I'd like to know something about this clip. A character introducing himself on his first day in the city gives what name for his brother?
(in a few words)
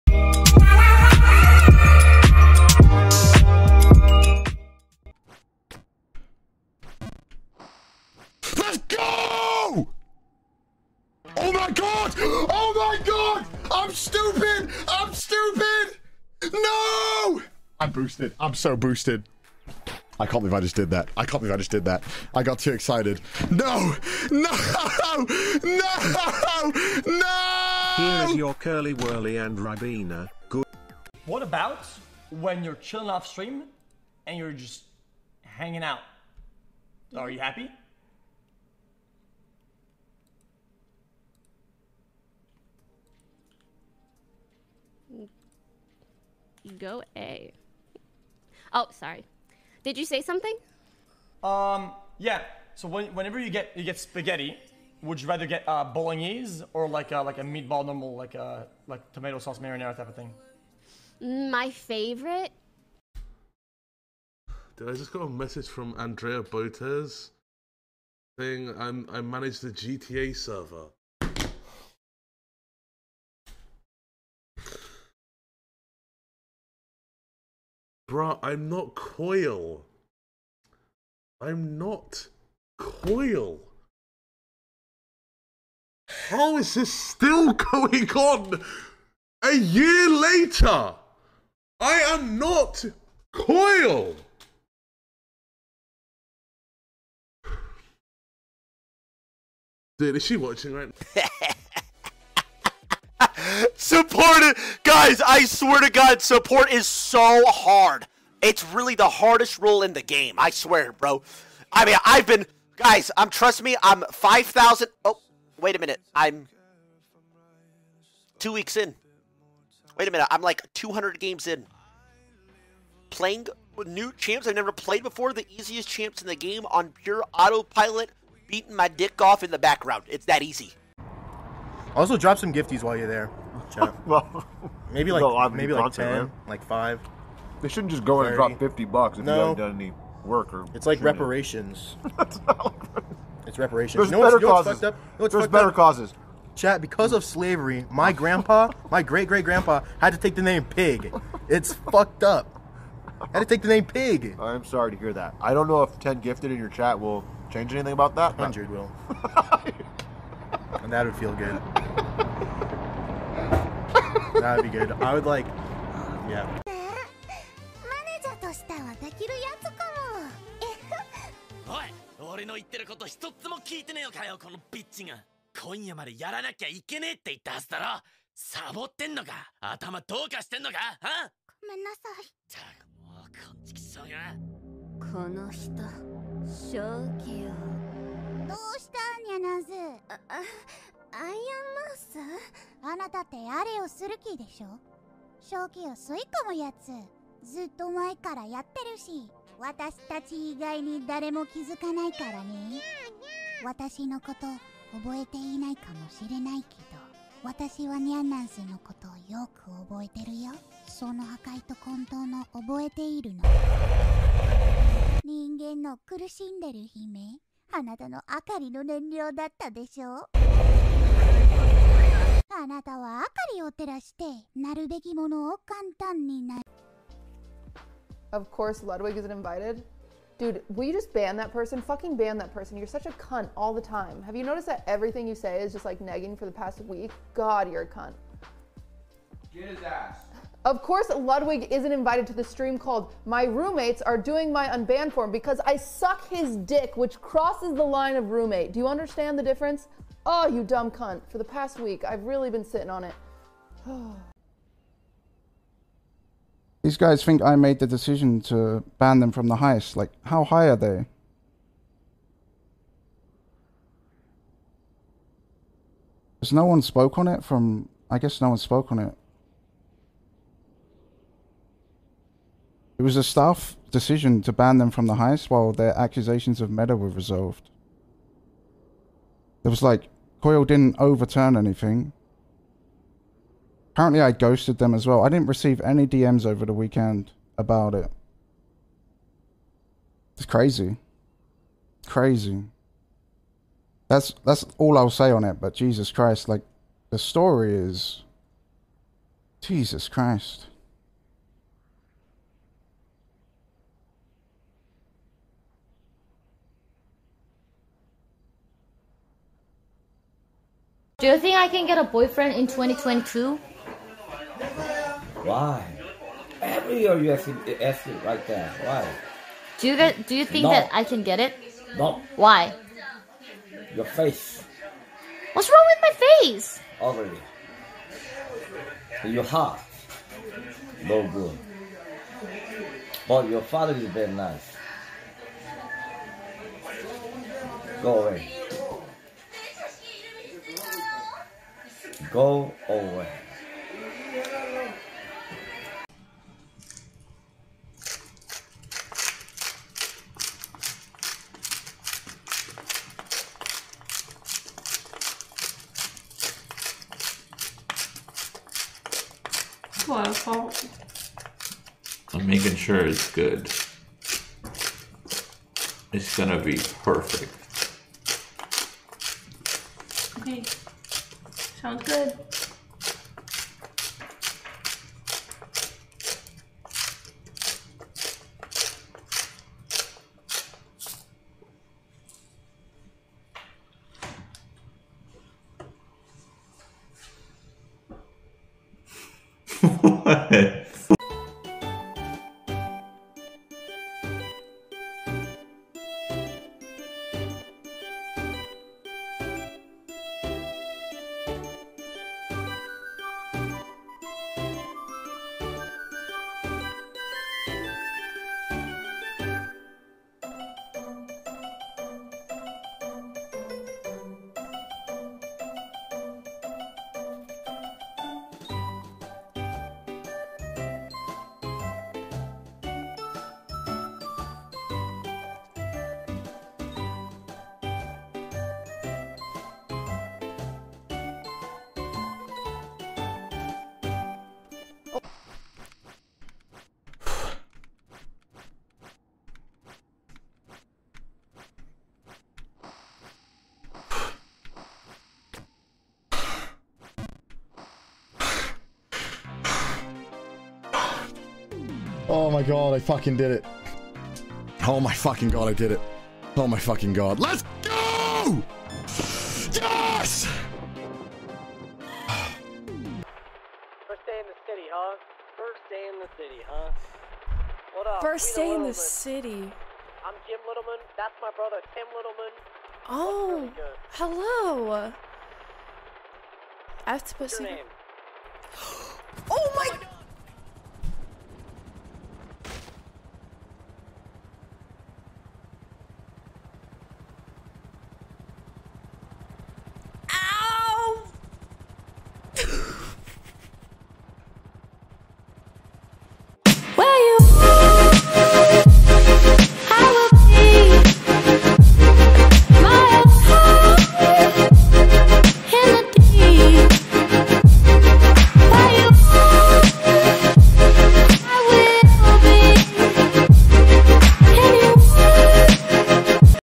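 Tim Littleman.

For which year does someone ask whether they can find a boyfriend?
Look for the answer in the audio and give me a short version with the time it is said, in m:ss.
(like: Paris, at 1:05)
2022, at 5:12.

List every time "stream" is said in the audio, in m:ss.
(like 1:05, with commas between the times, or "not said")
0:33, 4:02.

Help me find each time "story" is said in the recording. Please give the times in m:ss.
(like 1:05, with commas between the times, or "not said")
4:57.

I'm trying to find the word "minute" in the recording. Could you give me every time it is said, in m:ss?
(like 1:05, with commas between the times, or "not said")
1:55, 2:00.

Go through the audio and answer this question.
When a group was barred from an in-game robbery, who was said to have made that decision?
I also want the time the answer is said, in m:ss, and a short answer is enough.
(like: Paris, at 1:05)
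staff, at 4:33.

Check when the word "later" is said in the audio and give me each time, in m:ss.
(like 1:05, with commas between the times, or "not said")
1:30.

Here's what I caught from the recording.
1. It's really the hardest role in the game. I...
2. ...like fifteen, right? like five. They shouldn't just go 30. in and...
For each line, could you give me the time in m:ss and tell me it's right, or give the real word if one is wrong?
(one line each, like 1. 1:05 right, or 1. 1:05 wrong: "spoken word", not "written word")
1. 1:48 right
2. 2:15 wrong: "ten", not "fifteen".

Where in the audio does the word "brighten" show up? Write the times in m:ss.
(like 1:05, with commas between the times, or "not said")
not said.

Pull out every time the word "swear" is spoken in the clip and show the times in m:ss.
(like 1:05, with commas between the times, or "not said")
1:45, 1:50.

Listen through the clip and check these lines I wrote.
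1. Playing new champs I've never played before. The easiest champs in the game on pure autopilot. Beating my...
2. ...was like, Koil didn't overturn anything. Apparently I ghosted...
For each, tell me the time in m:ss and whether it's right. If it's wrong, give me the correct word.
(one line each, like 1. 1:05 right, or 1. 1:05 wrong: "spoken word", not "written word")
1. 2:03 right
2. 4:39 right.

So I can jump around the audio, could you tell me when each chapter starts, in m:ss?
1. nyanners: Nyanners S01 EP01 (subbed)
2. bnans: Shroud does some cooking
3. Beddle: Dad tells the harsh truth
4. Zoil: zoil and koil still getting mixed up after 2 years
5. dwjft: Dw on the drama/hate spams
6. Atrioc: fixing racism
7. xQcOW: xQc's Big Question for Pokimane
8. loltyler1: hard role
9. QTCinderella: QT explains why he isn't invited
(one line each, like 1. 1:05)
1. 2:41
2. 5:40
3. 5:05
4. 0:57
5. 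4:09
6. 2:05
7. 0:26
8. 1:35
9. 3:41.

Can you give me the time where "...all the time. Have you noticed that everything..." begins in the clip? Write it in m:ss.
3:53.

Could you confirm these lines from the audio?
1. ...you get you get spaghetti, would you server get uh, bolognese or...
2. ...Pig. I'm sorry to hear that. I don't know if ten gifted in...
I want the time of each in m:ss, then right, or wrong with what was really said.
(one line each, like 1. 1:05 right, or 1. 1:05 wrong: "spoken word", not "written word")
1. 0:53 wrong: "rather", not "server"
2. 2:33 right.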